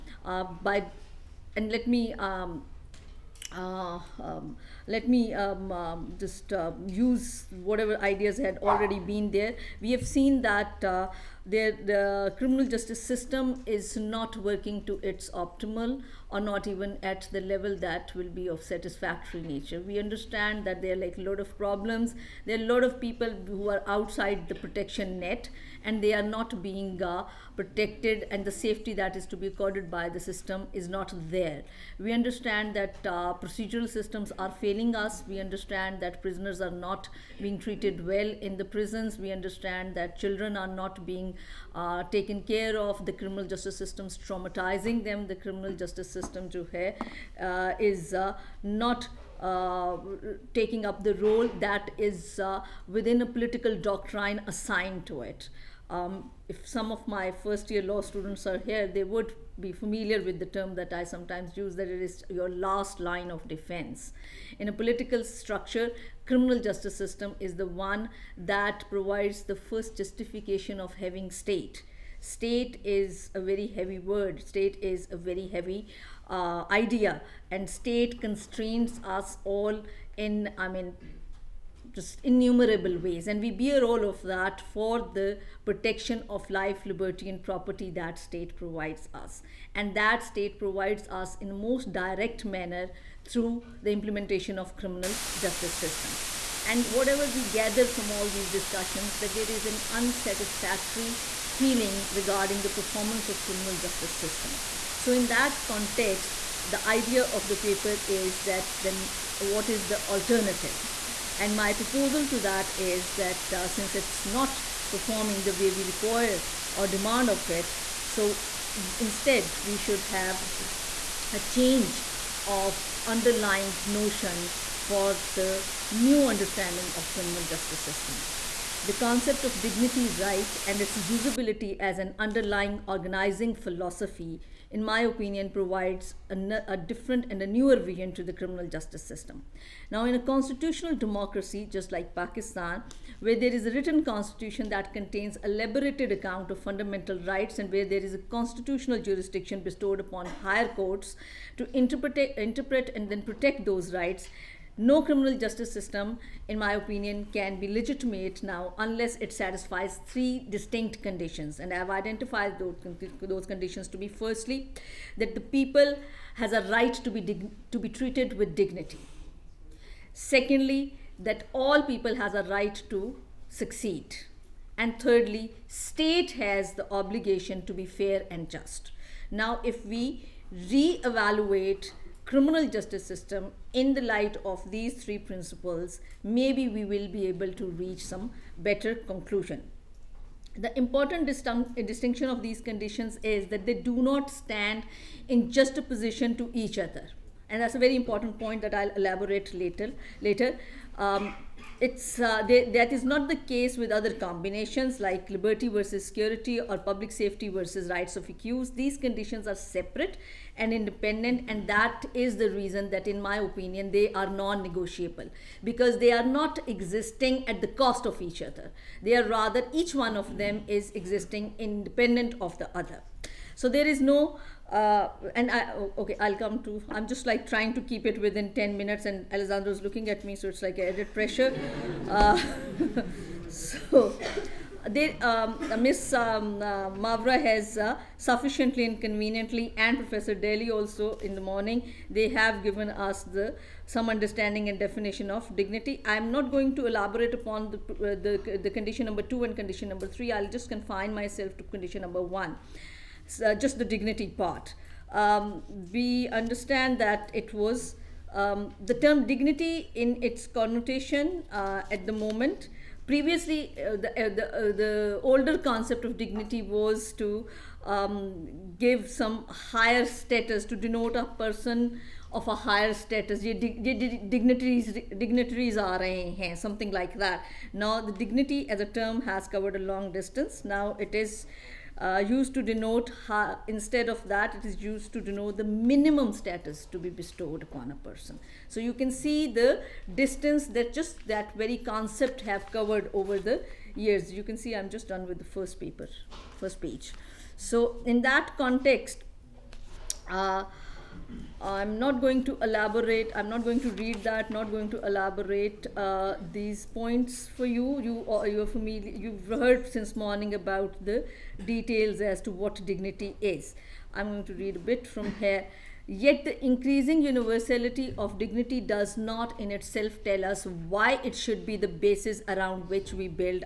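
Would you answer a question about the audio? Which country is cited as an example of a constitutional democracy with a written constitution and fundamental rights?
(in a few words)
Pakistan.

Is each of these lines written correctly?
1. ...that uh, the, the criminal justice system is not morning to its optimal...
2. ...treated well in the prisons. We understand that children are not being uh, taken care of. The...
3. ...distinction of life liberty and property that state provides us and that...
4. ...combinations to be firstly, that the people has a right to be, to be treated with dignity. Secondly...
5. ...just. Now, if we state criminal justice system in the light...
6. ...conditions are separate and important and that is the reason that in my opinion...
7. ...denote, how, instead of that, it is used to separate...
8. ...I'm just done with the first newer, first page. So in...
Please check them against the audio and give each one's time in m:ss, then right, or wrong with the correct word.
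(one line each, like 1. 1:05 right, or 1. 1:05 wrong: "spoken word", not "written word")
1. 0:10 wrong: "working", not "morning"
2. 0:37 right
3. 1:25 wrong: "protection", not "distinction"
4. 2:43 wrong: "conditions", not "combinations"
5. 2:58 wrong: "reevaluate", not "state"
6. 3:28 wrong: "independent", not "important"
7. 4:42 wrong: "denote", not "separate"
8. 4:54 wrong: "paper", not "newer".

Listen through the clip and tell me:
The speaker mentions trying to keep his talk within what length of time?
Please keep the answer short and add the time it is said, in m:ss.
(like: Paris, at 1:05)
10 minutes, at 3:48.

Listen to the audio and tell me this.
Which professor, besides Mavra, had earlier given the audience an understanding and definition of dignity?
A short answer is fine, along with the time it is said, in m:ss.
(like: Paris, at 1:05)
Professor Daly, at 3:59.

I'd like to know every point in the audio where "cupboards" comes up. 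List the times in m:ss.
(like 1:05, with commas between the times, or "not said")
not said.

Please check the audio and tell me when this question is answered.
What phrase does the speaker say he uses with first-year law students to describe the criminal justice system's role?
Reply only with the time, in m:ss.
1:02.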